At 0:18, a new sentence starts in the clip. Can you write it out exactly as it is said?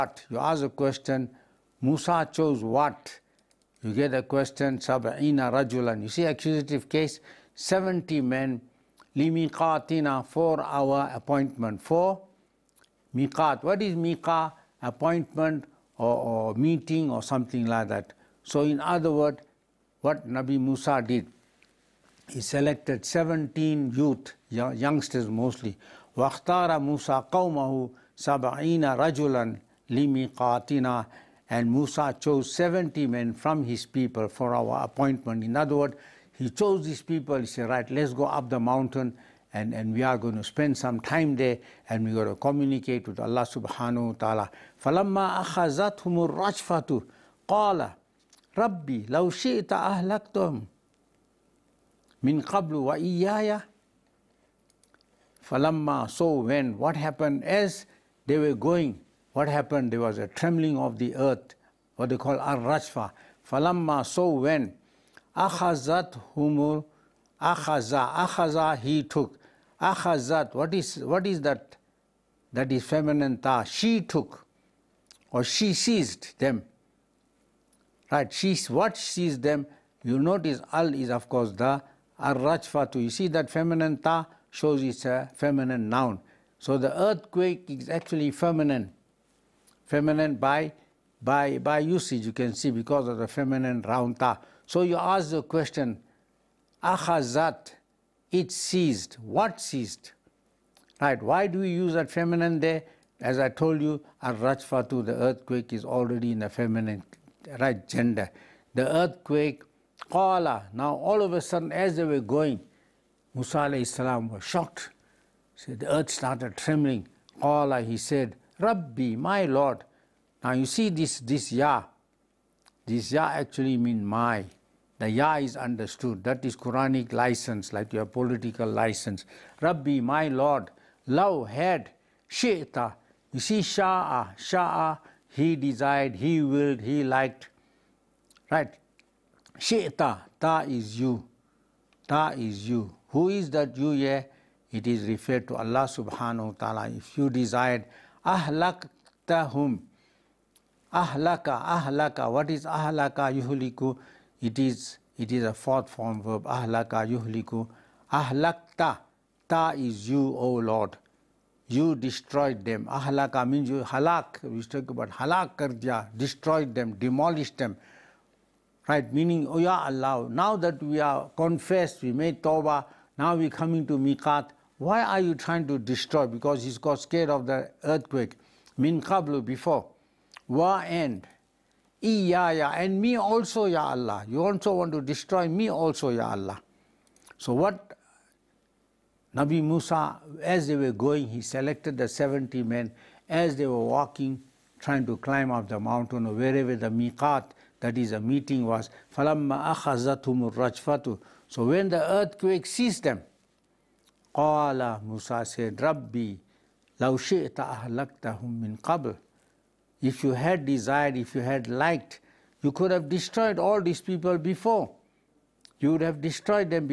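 So in other words, what Nabi Musa did he selected 17 youth, youngsters mostly.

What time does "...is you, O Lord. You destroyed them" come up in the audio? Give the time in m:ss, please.
2:39.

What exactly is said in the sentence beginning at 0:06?
You see accusative case, 70 men, limiqatina, for our appointment.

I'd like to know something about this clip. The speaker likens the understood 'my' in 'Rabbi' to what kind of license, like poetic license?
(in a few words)
Quranic license.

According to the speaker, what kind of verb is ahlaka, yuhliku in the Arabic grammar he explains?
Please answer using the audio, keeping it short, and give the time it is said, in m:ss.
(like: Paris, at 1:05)
Fourth form verb, at 2:35.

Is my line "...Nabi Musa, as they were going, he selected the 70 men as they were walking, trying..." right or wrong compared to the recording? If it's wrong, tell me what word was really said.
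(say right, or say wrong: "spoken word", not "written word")
right.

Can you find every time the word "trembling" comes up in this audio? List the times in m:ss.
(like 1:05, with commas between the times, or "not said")
1:00, 1:56.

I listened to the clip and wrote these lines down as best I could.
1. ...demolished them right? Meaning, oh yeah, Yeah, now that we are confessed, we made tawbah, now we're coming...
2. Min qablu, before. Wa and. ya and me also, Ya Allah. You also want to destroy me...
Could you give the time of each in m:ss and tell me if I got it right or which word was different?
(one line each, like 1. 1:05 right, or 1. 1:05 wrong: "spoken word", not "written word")
1. 2:46 wrong: "Allah", not "Yeah"
2. 2:58 right.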